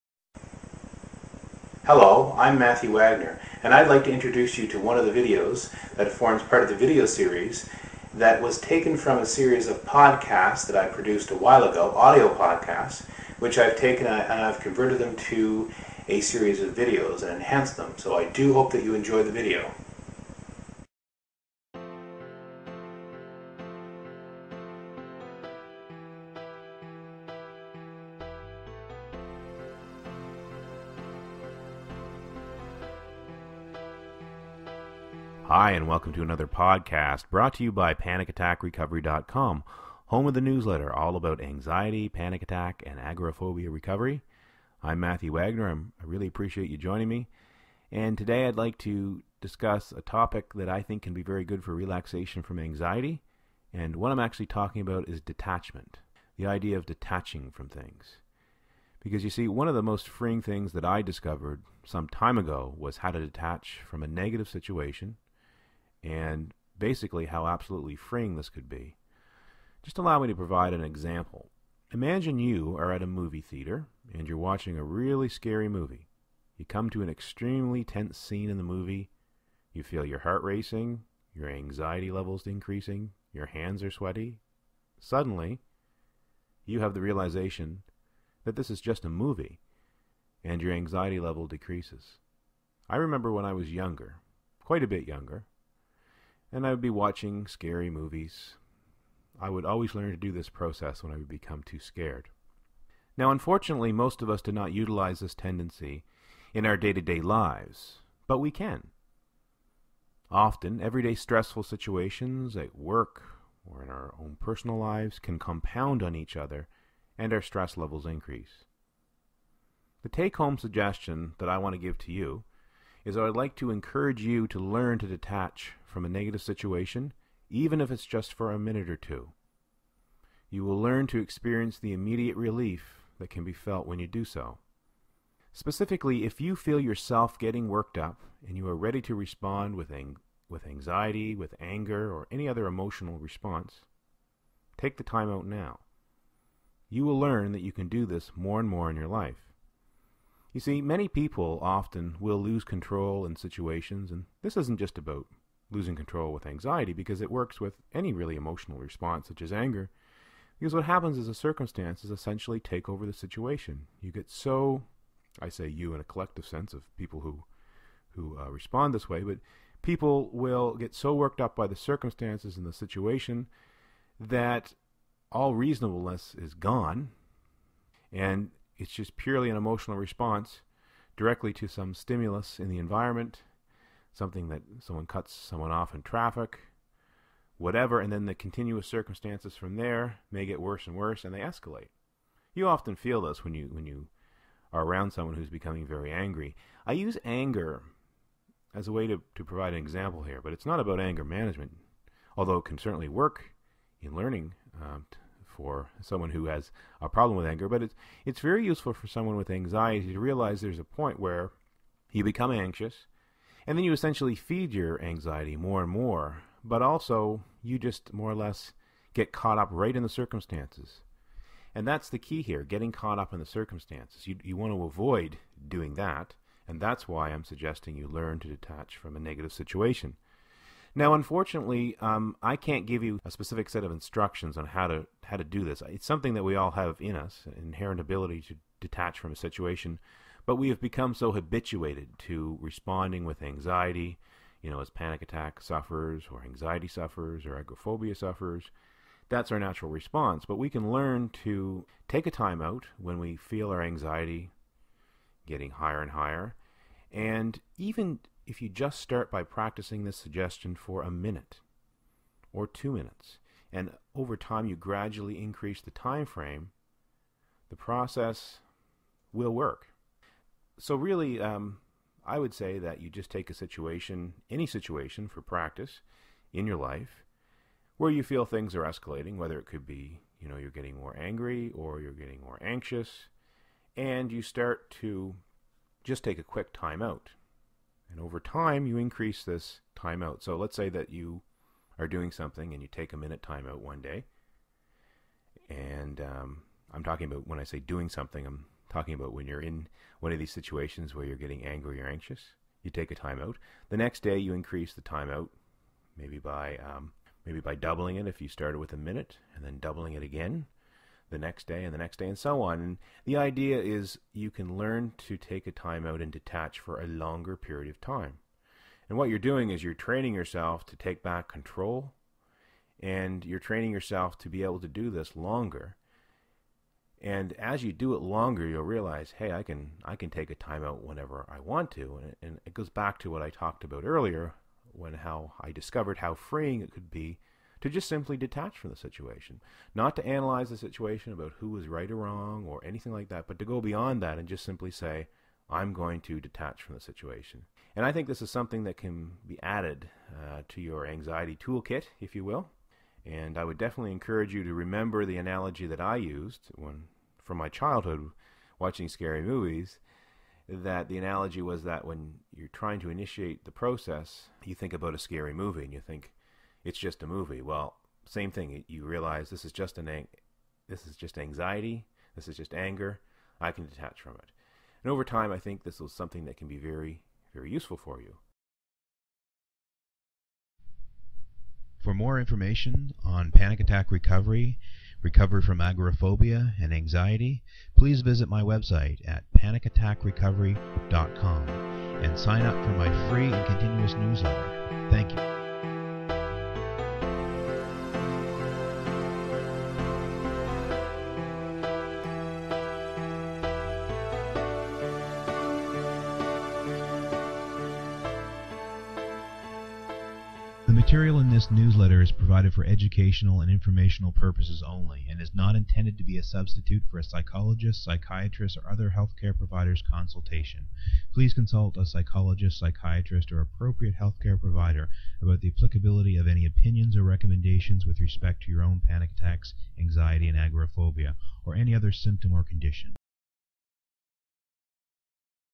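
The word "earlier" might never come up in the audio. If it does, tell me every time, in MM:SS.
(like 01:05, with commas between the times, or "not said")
05:34.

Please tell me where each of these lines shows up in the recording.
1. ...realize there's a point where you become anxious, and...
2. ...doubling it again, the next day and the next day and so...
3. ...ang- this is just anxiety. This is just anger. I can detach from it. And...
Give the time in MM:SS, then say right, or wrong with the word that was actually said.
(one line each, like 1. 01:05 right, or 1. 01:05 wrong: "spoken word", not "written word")
1. 03:30 right
2. 05:09 right
3. 06:10 right.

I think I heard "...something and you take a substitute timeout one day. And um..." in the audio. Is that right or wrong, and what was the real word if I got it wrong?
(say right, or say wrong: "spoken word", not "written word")
wrong: "minute", not "substitute".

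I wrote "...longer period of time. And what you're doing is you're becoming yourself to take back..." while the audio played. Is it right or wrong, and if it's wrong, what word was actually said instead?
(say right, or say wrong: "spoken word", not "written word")
wrong: "training", not "becoming".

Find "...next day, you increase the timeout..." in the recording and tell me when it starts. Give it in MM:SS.
05:03.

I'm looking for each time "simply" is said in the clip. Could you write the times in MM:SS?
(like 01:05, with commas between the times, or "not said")
05:38, 05:44.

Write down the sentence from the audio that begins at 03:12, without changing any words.
You often feel this when you when you are around someone who's becoming very angry.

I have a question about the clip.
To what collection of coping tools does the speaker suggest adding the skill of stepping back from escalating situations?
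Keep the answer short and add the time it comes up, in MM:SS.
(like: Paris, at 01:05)
anxiety toolkit, at 05:51.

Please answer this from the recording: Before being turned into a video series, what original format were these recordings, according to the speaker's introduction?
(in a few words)
audio podcasts.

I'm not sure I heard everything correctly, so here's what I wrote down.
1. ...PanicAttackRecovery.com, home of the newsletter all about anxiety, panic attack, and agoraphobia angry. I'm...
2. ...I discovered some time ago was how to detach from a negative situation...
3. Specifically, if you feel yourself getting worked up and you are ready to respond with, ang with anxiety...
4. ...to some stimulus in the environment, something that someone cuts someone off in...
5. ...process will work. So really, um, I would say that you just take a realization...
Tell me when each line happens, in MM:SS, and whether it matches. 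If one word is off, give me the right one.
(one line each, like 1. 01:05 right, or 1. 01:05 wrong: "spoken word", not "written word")
1. 00:37 wrong: "recovery", not "angry"
2. 01:00 right
3. 02:15 right
4. 03:01 right
5. 04:27 wrong: "situation", not "realization".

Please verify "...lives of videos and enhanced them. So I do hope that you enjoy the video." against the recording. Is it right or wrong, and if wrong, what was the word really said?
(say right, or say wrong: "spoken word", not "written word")
wrong: "series", not "lives".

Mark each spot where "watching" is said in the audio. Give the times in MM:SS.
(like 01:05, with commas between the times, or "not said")
01:14, 01:36, 05:58.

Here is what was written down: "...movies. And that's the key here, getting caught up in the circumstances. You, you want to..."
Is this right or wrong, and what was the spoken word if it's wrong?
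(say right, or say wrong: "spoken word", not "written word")
wrong: "circumstances", not "movies".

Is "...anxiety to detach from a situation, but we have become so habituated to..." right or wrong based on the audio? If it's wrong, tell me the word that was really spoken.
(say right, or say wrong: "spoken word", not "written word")
wrong: "ability", not "anxiety".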